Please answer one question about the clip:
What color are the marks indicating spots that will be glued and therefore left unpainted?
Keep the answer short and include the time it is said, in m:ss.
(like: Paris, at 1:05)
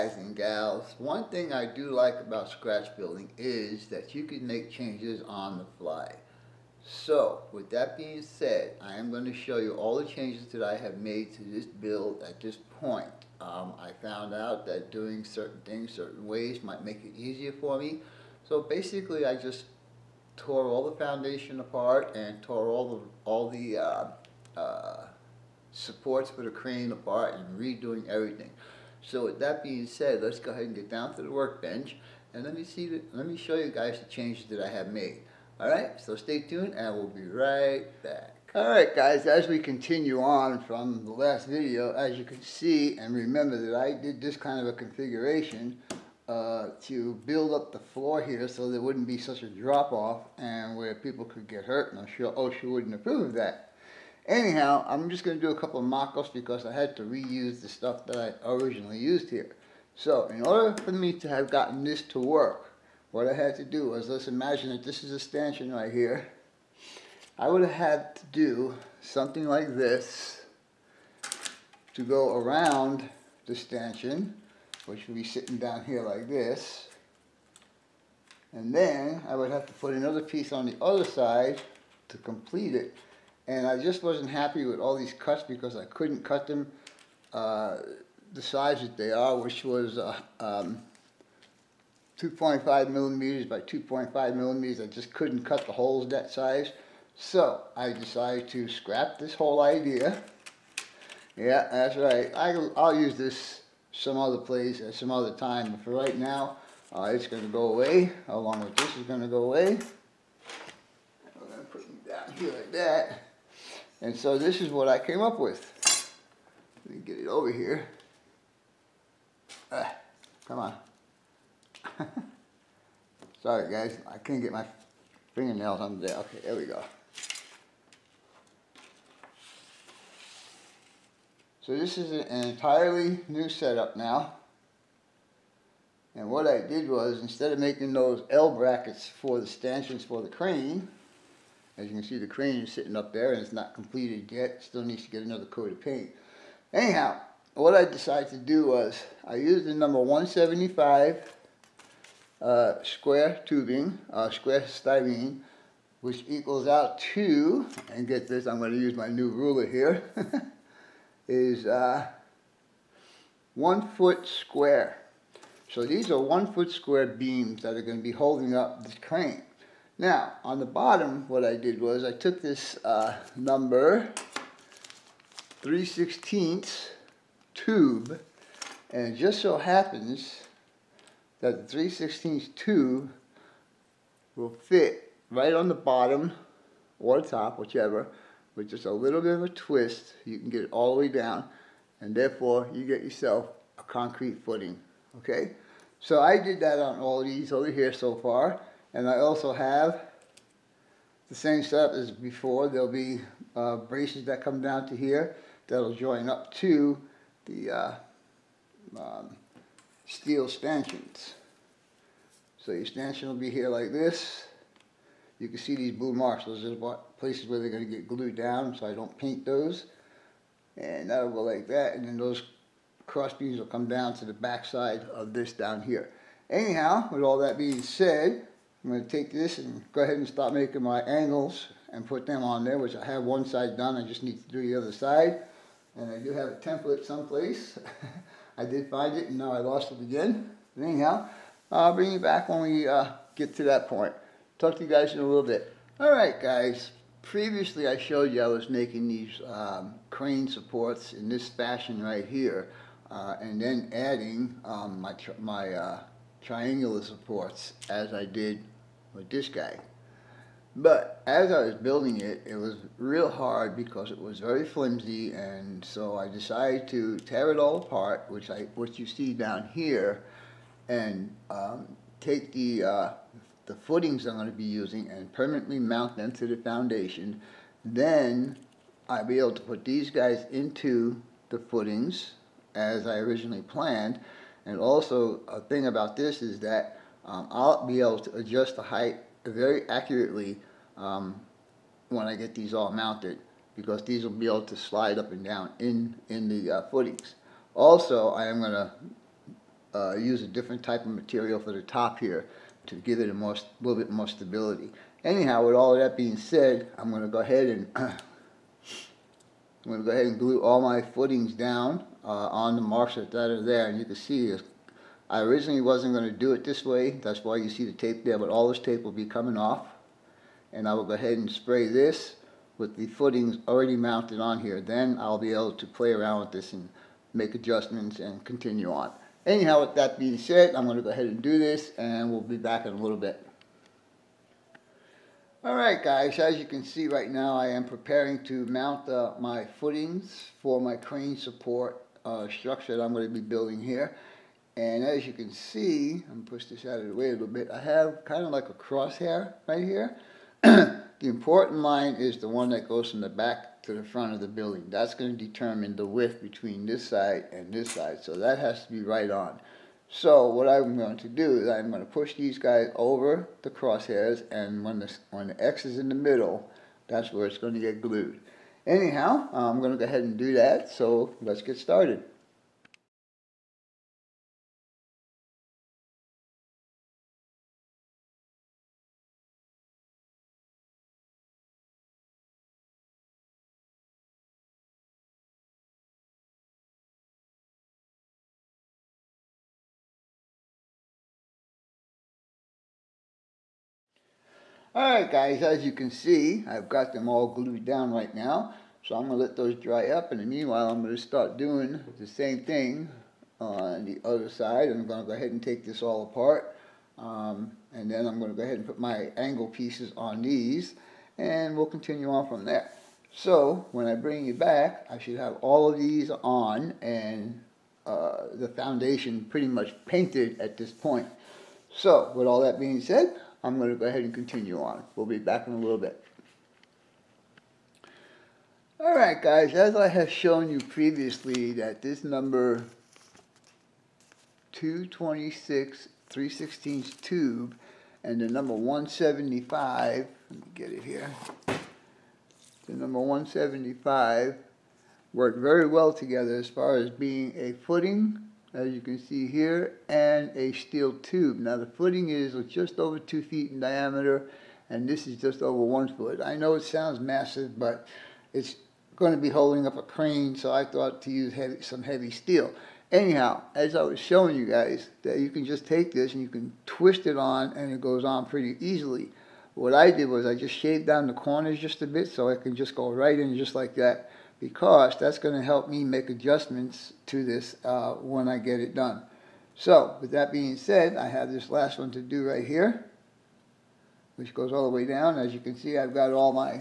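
blue, at 3:35.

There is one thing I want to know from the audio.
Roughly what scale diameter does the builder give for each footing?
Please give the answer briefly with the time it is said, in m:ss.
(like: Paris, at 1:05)
just over 2 feet, at 7:32.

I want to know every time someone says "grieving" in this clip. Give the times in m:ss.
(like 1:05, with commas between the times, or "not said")
not said.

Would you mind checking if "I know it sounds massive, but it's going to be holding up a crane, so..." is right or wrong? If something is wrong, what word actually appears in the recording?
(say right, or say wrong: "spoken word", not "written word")
right.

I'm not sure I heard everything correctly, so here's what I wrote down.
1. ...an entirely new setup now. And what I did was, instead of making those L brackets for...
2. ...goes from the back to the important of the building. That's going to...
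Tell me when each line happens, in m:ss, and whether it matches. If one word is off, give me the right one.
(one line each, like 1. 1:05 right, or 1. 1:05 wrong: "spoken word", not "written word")
1. 2:12 right
2. 5:52 wrong: "front", not "important".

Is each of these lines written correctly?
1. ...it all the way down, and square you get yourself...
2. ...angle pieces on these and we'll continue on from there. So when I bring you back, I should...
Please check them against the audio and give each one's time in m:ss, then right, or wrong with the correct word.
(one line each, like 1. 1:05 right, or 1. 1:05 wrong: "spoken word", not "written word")
1. 3:10 wrong: "therefore", not "square"
2. 6:49 right.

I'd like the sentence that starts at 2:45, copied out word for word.
So these are one foot square beams that are going to be holding up this crane.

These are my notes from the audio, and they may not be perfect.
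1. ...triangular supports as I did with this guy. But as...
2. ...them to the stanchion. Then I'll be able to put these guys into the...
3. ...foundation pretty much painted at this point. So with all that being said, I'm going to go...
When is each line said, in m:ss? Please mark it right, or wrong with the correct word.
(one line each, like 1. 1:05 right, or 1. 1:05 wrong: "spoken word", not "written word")
1. 4:16 right
2. 4:36 wrong: "foundation", not "stanchion"
3. 6:58 right.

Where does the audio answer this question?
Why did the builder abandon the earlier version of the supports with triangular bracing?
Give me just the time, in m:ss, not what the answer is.
4:24.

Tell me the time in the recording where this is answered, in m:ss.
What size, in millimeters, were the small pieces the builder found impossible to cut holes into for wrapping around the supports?
1:32.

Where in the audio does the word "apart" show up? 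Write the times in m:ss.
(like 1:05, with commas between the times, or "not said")
0:21, 0:26, 4:27, 6:46.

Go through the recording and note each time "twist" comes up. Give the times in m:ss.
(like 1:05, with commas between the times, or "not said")
3:09, 7:46.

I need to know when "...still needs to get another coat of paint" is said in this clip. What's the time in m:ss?
2:24.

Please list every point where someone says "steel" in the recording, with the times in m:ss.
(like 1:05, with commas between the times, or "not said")
3:30, 7:30, 7:42.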